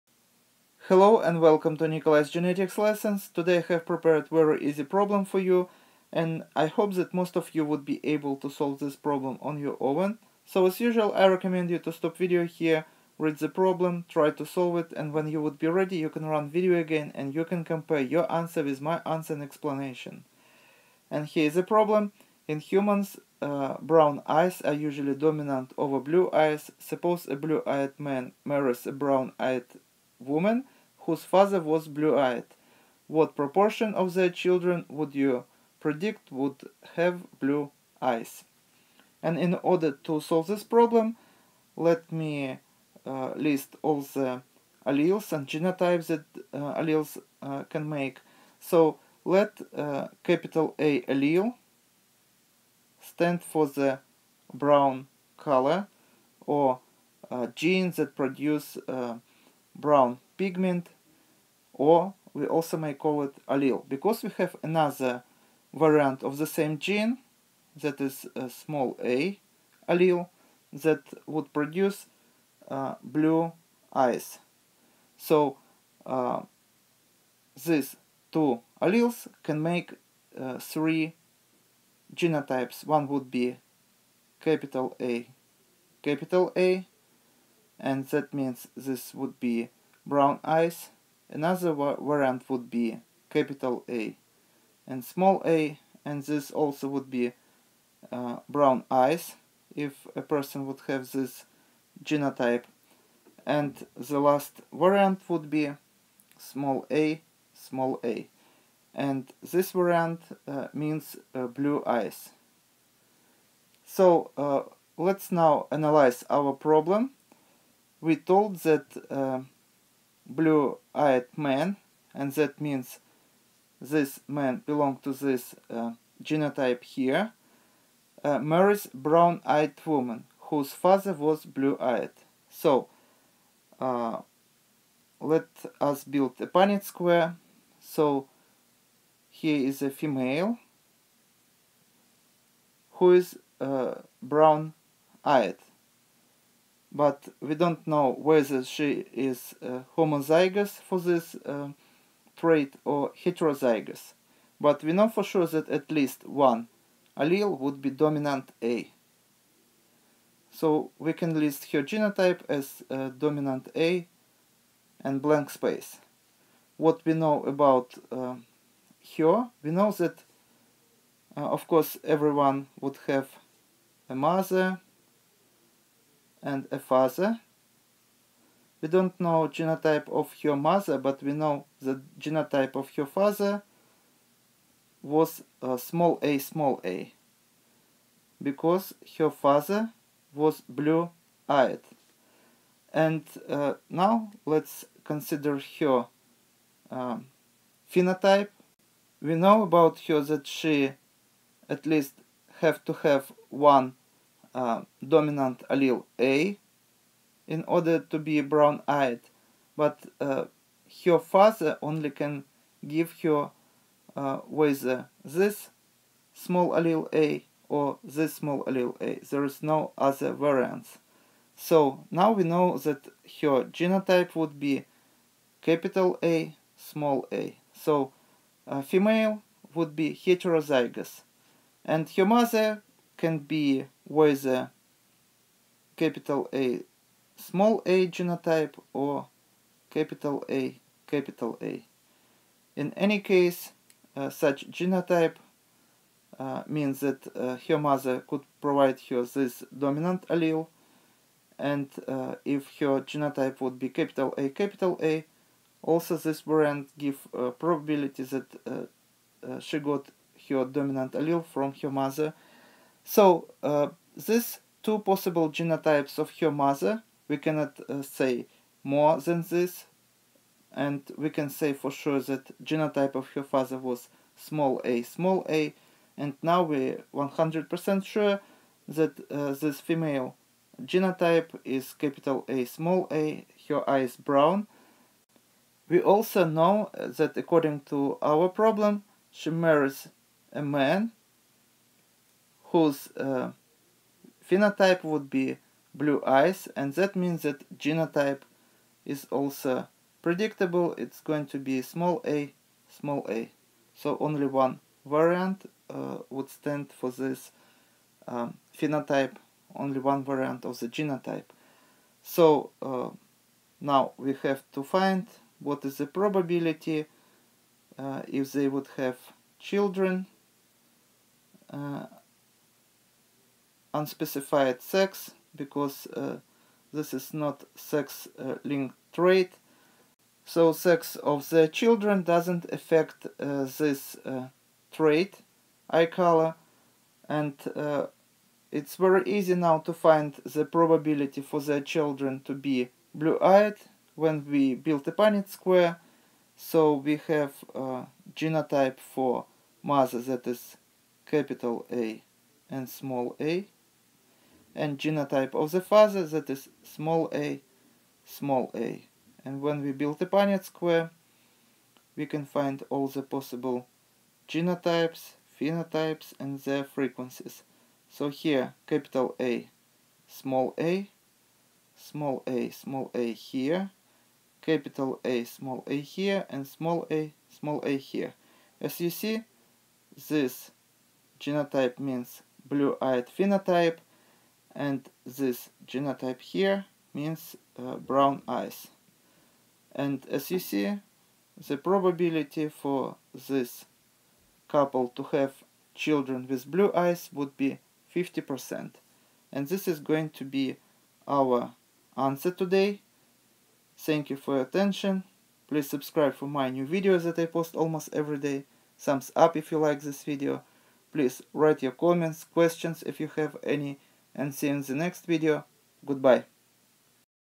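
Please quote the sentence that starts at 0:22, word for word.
In humans uh, brown eyes are usually dominant over blue eyes.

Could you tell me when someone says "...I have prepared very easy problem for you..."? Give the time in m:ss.
0:03.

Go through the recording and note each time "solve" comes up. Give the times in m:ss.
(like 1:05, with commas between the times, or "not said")
0:08, 0:14, 0:40.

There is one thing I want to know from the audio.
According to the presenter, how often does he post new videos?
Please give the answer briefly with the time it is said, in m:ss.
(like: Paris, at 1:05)
Almost every day, at 6:47.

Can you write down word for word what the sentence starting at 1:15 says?
So uh, these two alleles can make uh, three genotypes.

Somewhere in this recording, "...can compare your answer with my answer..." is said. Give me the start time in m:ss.
0:17.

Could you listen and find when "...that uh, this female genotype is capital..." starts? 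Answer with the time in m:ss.
4:38.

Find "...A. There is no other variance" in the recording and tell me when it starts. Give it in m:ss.
3:38.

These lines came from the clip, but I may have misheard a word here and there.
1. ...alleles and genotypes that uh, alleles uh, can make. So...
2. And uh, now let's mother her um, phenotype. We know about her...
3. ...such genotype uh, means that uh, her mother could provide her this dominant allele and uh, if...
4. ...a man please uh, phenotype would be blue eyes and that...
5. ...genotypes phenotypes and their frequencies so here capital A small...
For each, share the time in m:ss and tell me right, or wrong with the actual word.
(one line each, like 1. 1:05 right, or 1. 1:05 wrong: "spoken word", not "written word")
1. 0:44 right
2. 3:12 wrong: "consider", not "mother"
3. 4:04 right
4. 4:50 wrong: "whose", not "please"
5. 6:04 right.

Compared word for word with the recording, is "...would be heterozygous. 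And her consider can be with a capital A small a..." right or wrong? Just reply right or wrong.
wrong.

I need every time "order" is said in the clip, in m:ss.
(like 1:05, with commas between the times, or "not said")
0:39, 3:27.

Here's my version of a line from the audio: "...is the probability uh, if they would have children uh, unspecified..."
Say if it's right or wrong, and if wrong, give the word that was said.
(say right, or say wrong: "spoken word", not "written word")
right.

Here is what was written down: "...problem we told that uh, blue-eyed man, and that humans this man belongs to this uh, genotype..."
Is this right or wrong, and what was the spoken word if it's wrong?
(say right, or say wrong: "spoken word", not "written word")
wrong: "means", not "humans".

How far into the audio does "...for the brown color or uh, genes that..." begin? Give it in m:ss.
0:53.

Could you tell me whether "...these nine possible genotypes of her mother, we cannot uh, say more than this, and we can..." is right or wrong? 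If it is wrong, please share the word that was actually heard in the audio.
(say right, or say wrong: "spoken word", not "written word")
wrong: "two", not "nine".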